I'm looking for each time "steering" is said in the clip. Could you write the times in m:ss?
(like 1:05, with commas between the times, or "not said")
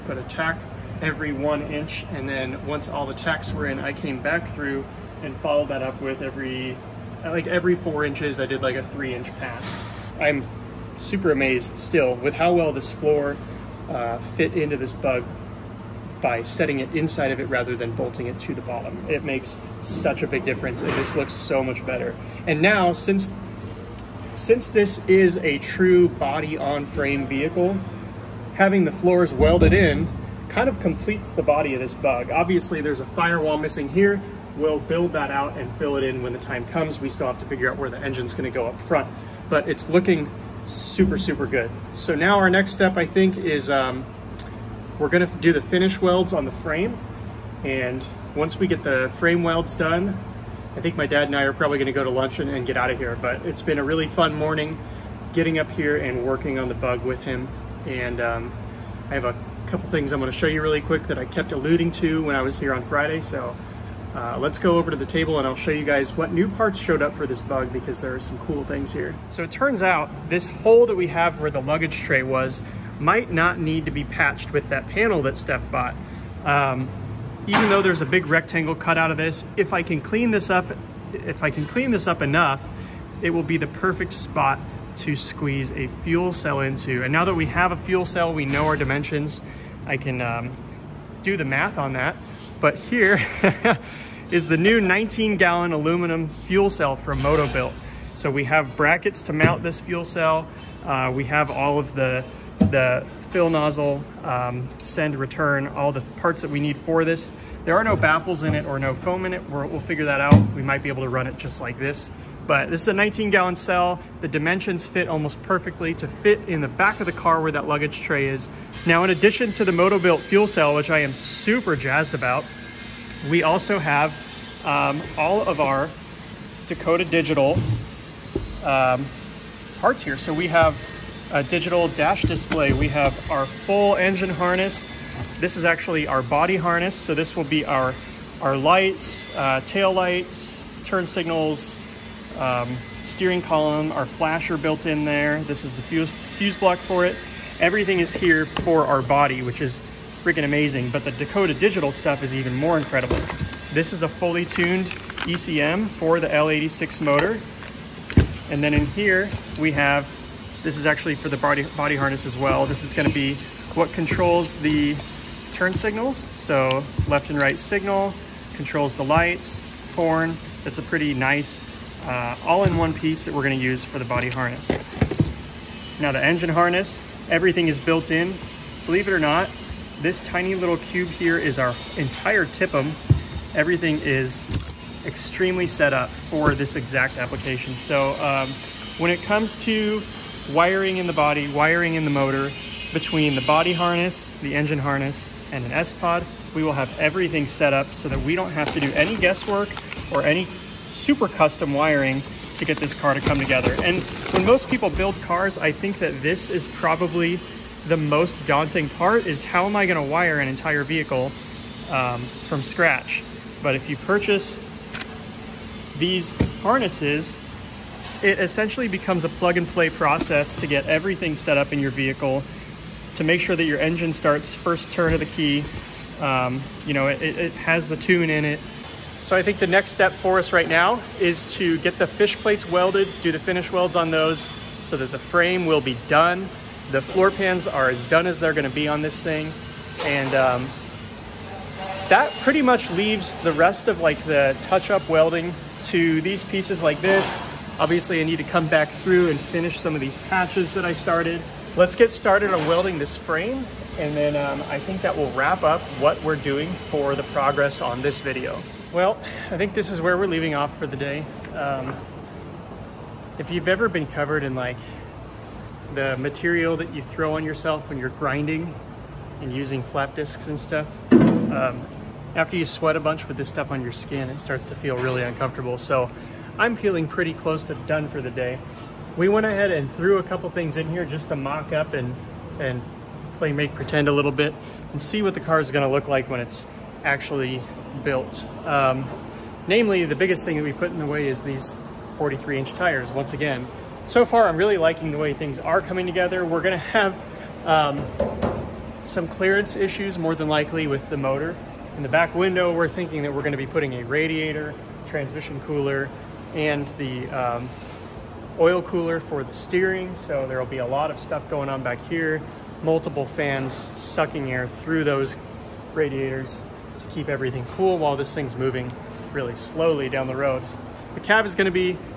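2:23, 5:09.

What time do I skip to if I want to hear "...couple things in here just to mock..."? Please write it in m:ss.
4:40.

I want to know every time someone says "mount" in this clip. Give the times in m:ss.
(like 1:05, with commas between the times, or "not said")
1:39.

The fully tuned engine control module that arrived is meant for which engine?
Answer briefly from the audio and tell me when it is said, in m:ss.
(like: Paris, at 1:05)
L86, at 2:36.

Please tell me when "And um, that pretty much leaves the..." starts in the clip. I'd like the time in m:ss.
4:00.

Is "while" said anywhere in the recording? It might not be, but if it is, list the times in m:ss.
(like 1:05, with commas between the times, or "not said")
5:17.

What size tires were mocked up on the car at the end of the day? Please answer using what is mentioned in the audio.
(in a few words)
43 inch.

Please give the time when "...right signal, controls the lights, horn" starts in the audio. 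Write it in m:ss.
2:47.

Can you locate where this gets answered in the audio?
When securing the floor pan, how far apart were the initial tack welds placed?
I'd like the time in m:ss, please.
0:01.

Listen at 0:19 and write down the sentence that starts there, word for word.
It makes such a big difference and this looks so much better.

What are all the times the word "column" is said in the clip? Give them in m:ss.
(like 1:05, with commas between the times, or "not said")
2:23.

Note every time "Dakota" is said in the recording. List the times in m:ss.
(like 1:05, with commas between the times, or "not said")
2:06, 2:31.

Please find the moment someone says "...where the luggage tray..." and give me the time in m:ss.
1:11.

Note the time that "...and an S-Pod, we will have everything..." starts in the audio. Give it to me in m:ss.
3:15.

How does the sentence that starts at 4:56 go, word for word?
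We're gonna have um, some clearance issues more than likely with the motor.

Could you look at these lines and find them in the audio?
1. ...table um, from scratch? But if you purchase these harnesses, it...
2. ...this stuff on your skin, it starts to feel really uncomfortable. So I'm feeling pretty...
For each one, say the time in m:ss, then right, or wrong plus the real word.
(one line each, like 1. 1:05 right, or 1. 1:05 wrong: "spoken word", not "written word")
1. 3:30 wrong: "vehicle", not "table"
2. 4:33 right.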